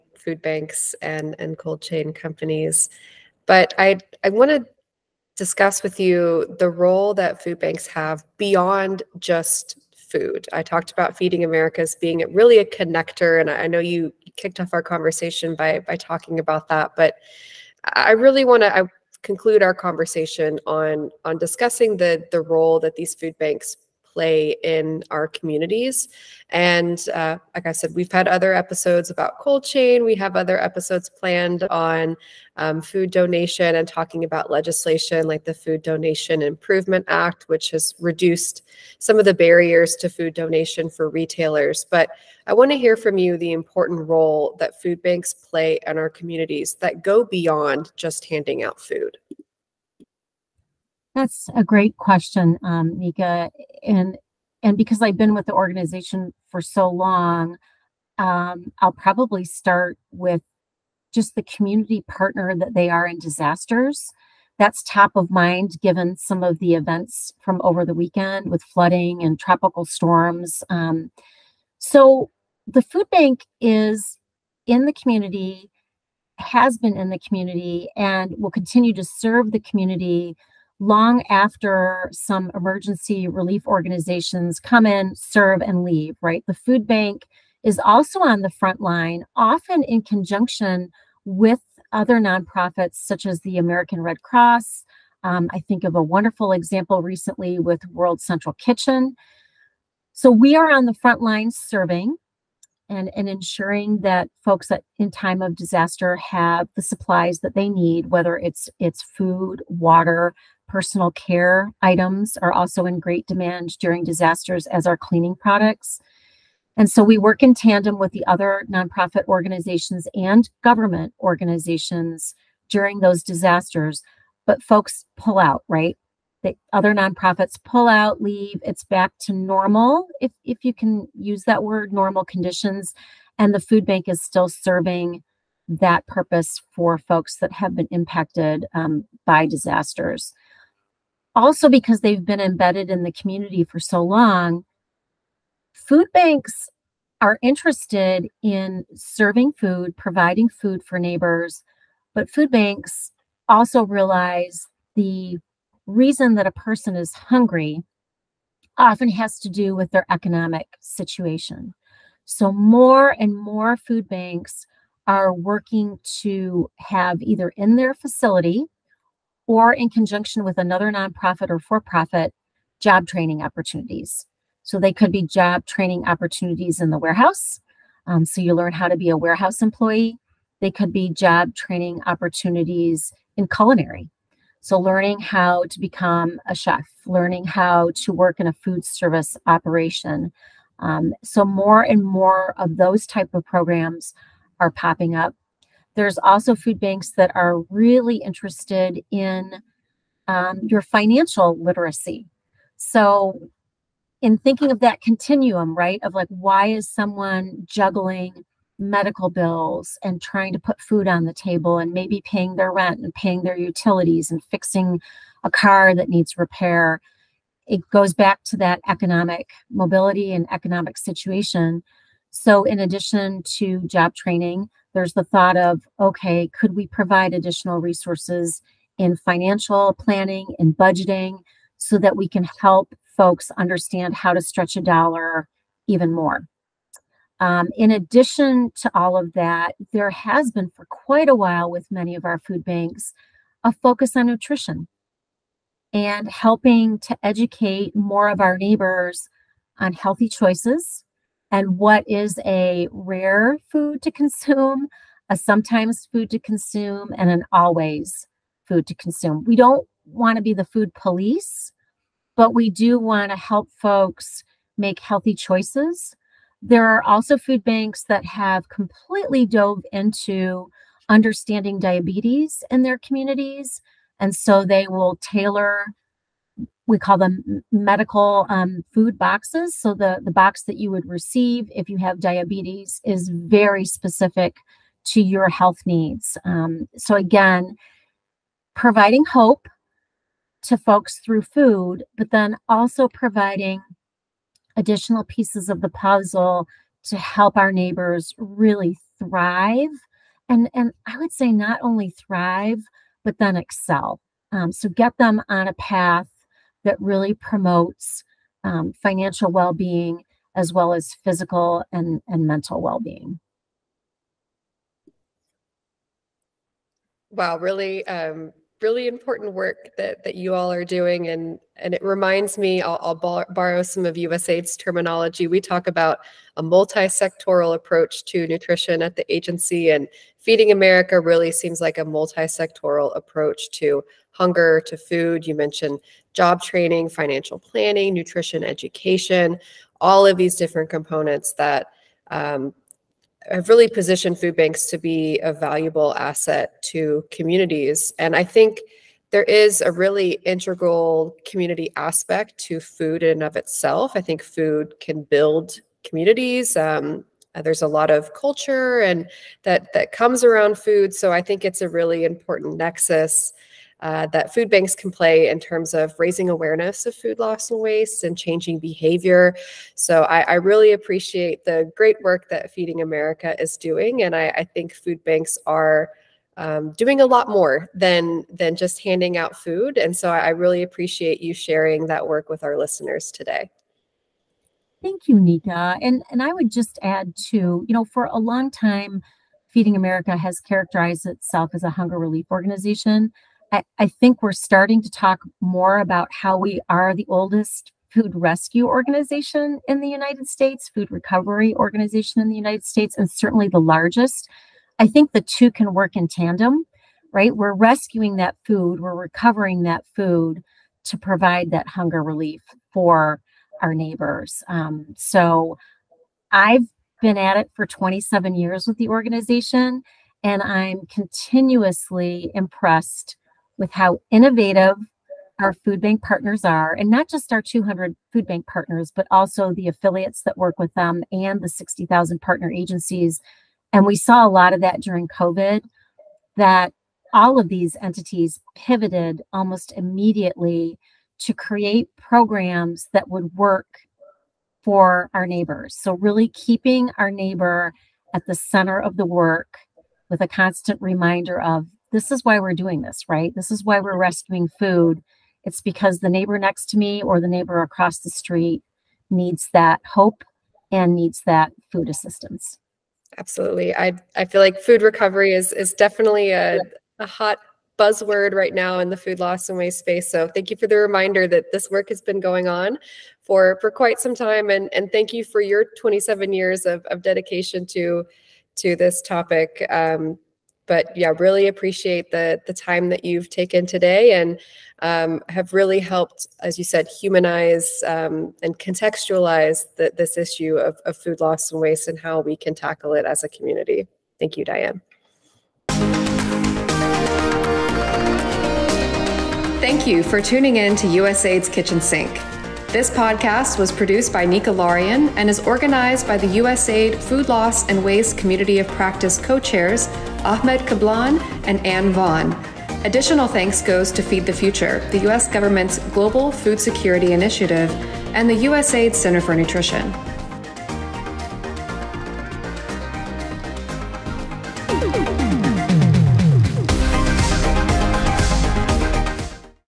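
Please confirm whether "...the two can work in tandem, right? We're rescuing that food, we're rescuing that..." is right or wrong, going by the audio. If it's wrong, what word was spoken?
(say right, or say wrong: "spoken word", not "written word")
wrong: "recovering", not "rescuing".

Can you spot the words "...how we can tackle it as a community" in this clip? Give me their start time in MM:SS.
08:12.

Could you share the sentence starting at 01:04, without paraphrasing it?
That's top of mind given some of the events from over the weekend with flooding and tropical storms.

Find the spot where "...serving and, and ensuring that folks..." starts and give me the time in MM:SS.
01:41.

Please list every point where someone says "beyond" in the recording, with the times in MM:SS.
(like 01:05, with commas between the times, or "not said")
00:08, 00:47.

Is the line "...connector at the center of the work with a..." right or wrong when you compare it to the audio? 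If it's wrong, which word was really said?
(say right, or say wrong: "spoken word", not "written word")
wrong: "neighbor", not "connector".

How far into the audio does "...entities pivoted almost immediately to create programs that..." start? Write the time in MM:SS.
07:17.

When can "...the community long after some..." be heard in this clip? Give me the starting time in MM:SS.
01:19.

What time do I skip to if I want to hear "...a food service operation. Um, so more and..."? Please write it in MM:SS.
03:08.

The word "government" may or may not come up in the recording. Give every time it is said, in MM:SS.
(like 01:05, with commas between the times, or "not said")
02:00, 08:35.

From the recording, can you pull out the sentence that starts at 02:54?
So they could be job training opportunities in the warehouse.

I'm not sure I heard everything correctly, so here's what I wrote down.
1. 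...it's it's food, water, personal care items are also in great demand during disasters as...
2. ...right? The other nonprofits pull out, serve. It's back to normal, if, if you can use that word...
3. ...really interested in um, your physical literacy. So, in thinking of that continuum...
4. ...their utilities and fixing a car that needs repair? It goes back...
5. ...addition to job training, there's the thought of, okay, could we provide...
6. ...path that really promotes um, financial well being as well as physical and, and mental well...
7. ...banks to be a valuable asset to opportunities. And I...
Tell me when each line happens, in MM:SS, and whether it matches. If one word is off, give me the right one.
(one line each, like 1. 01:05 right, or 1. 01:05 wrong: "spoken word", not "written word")
1. 01:48 right
2. 02:05 wrong: "leave", not "serve"
3. 03:17 wrong: "financial", not "physical"
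4. 03:33 right
5. 03:42 right
6. 05:05 right
7. 05:44 wrong: "communities", not "opportunities".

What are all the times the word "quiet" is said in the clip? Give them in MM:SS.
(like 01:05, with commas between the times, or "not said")
not said.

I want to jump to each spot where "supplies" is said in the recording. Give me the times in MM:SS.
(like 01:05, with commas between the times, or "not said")
01:46.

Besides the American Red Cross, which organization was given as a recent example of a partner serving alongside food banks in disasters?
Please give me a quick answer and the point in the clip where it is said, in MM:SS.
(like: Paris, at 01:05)
World Central Kitchen, at 01:37.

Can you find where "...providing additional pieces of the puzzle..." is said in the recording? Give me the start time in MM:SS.
04:53.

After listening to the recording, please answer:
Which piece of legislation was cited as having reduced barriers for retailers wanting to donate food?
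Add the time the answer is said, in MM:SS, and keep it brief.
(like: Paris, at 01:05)
Food Donation Improvement Act, at 00:35.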